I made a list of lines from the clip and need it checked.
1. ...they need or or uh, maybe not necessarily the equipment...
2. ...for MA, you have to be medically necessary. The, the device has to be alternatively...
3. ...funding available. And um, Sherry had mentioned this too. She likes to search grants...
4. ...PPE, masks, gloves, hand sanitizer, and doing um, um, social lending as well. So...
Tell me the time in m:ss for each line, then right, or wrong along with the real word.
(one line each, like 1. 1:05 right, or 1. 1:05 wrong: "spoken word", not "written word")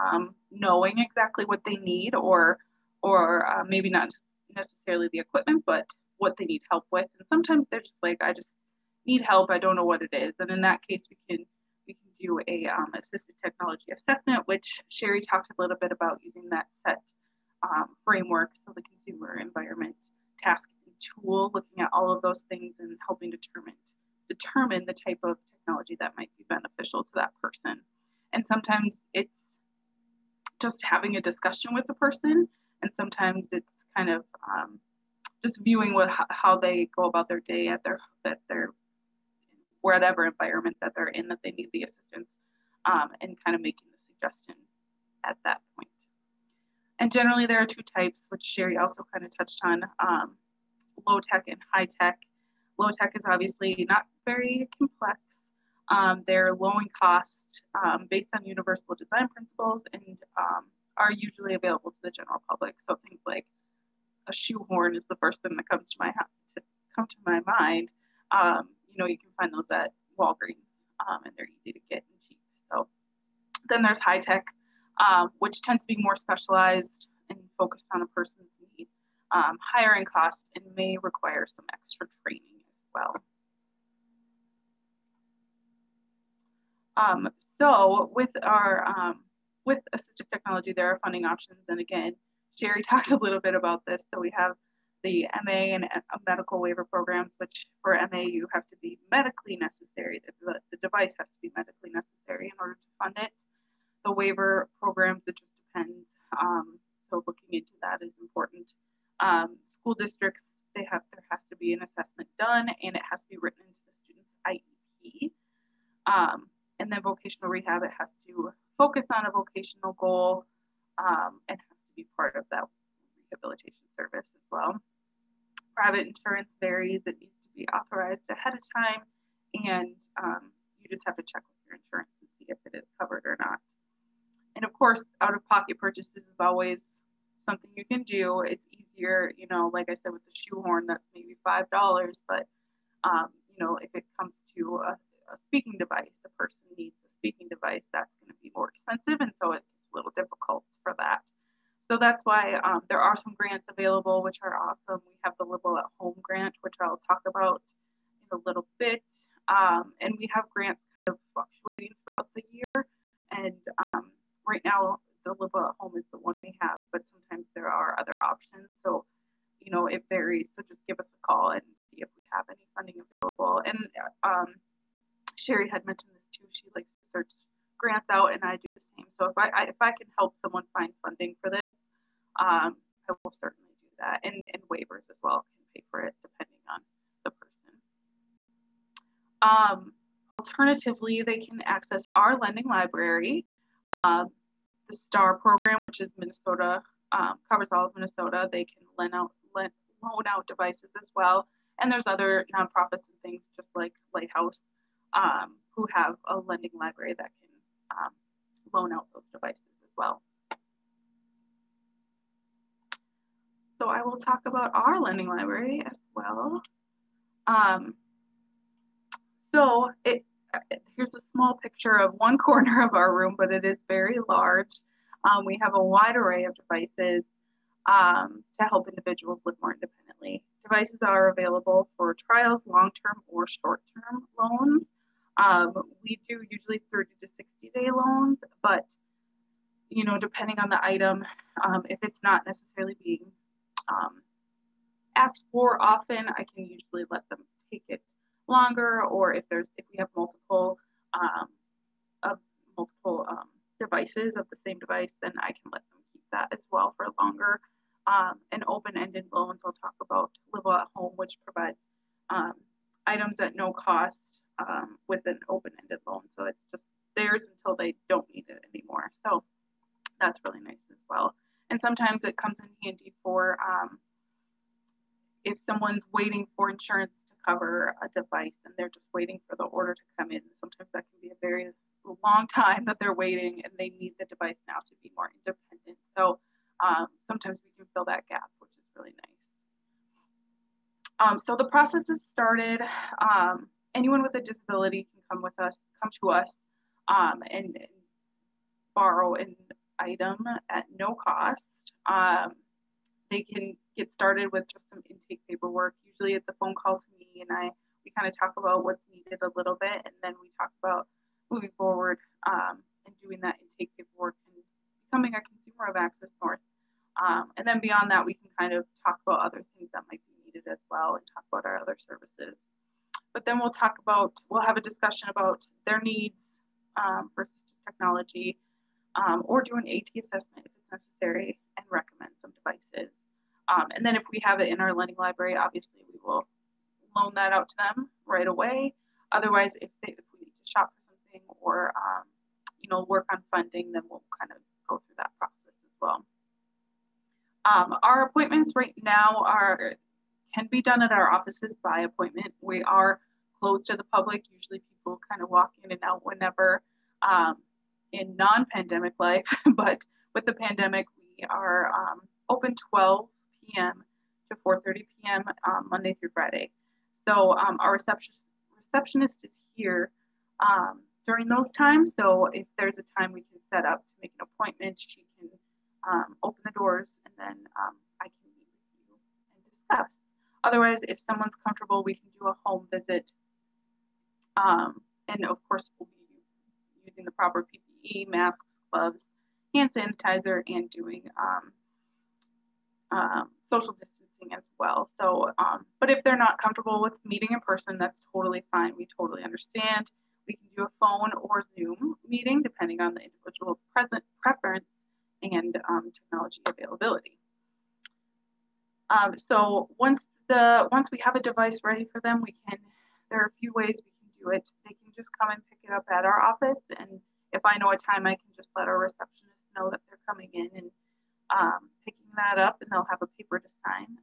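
1. 0:01 right
2. 1:37 wrong: "medically", not "alternatively"
3. 2:52 right
4. 6:27 wrong: "distancing", not "lending".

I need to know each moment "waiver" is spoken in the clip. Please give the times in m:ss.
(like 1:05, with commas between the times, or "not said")
1:36, 1:44, 3:04.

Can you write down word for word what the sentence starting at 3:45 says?
Um, we have a wide array of devices um, to help individuals live more independently.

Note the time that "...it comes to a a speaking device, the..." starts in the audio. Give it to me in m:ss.
2:23.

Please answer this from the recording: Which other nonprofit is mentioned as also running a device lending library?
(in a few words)
Lighthouse.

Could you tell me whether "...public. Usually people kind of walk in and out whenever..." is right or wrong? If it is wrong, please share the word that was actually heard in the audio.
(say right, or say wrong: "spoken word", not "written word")
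right.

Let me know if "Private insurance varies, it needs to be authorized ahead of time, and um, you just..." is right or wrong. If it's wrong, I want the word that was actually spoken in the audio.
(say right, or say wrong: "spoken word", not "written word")
right.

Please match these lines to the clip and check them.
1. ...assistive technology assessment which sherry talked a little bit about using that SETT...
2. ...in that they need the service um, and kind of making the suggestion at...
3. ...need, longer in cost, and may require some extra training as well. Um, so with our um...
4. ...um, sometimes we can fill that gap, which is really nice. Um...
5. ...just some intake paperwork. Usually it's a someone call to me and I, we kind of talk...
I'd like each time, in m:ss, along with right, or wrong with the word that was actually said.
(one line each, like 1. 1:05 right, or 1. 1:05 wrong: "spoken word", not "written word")
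1. 0:12 right
2. 0:41 wrong: "assistance", not "service"
3. 1:18 wrong: "higher", not "longer"
4. 4:46 right
5. 5:04 wrong: "phone", not "someone".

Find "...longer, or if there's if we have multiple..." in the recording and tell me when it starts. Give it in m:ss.
4:08.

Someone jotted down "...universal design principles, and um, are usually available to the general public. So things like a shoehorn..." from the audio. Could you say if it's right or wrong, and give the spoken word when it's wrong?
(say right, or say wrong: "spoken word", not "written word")
right.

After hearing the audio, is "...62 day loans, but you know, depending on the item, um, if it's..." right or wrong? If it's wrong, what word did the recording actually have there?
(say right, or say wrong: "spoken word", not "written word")
wrong: "60", not "62".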